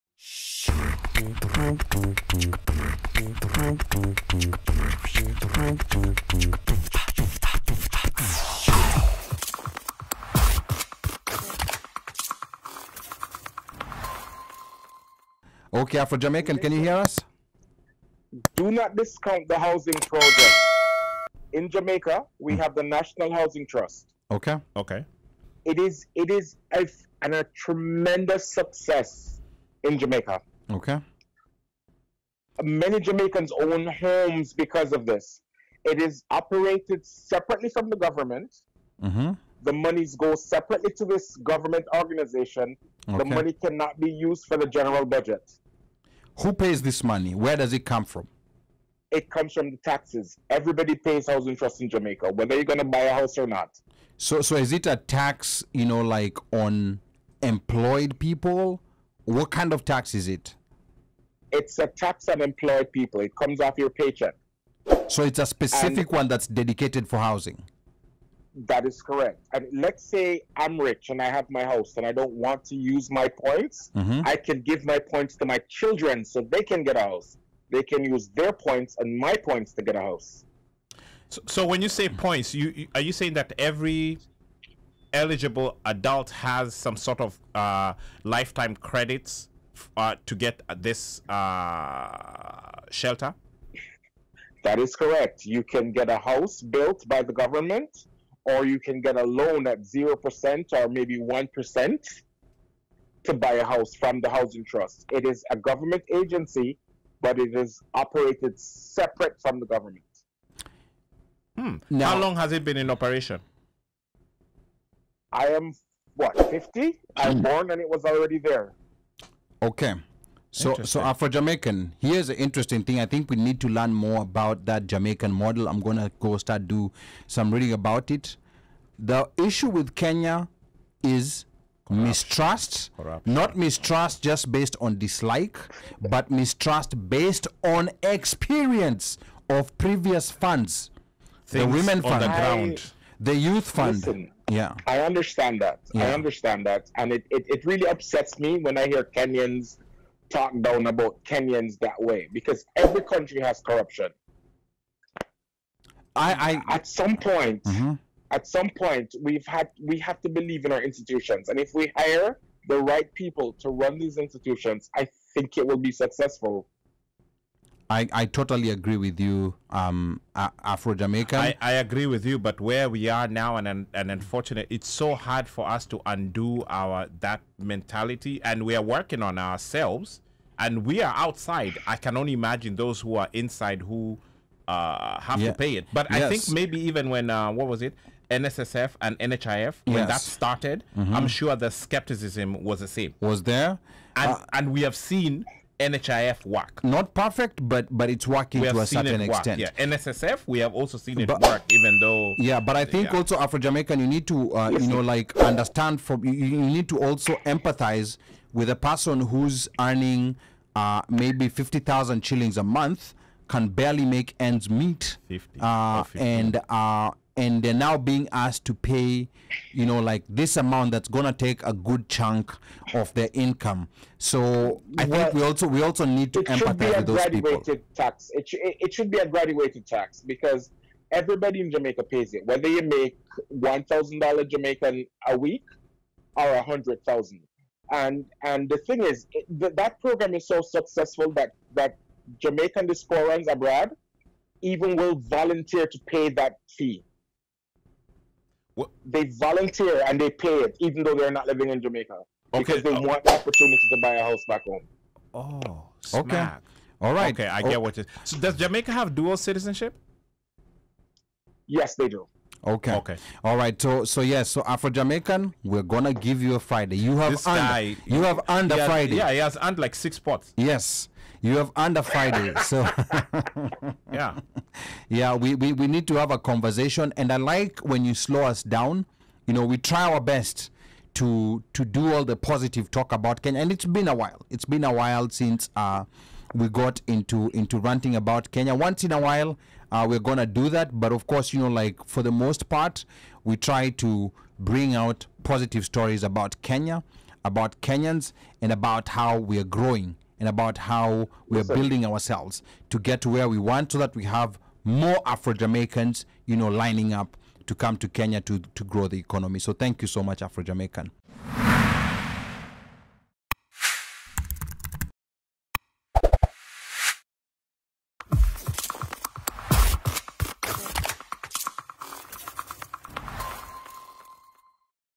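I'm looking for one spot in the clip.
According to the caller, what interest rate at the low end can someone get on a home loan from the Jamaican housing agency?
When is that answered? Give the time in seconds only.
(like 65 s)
99 s.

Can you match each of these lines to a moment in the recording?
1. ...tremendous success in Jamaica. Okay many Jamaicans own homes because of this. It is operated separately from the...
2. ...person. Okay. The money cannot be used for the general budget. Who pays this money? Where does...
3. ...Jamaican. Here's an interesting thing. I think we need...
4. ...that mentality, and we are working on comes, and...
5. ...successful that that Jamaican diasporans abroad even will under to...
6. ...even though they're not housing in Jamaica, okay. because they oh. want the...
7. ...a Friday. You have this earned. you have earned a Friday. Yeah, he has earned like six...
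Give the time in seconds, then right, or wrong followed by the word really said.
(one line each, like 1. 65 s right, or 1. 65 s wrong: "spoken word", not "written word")
1. 27 s right
2. 41 s wrong: "organization", not "person"
3. 121 s right
4. 177 s wrong: "ourselves", not "comes"
5. 240 s wrong: "volunteer", not "under"
6. 250 s wrong: "living", not "housing"
7. 266 s right.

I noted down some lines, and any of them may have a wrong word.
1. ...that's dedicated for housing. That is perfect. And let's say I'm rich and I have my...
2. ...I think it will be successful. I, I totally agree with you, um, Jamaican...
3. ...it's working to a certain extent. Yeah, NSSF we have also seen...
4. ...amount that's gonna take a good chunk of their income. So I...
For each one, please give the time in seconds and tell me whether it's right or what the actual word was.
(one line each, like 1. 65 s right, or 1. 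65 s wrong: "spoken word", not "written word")
1. 66 s wrong: "correct", not "perfect"
2. 164 s wrong: "Afro", not "Jamaican"
3. 198 s right
4. 220 s right.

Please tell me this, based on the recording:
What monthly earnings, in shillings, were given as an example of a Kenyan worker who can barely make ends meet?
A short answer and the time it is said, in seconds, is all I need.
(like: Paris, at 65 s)
50,000 shillings, at 211 s.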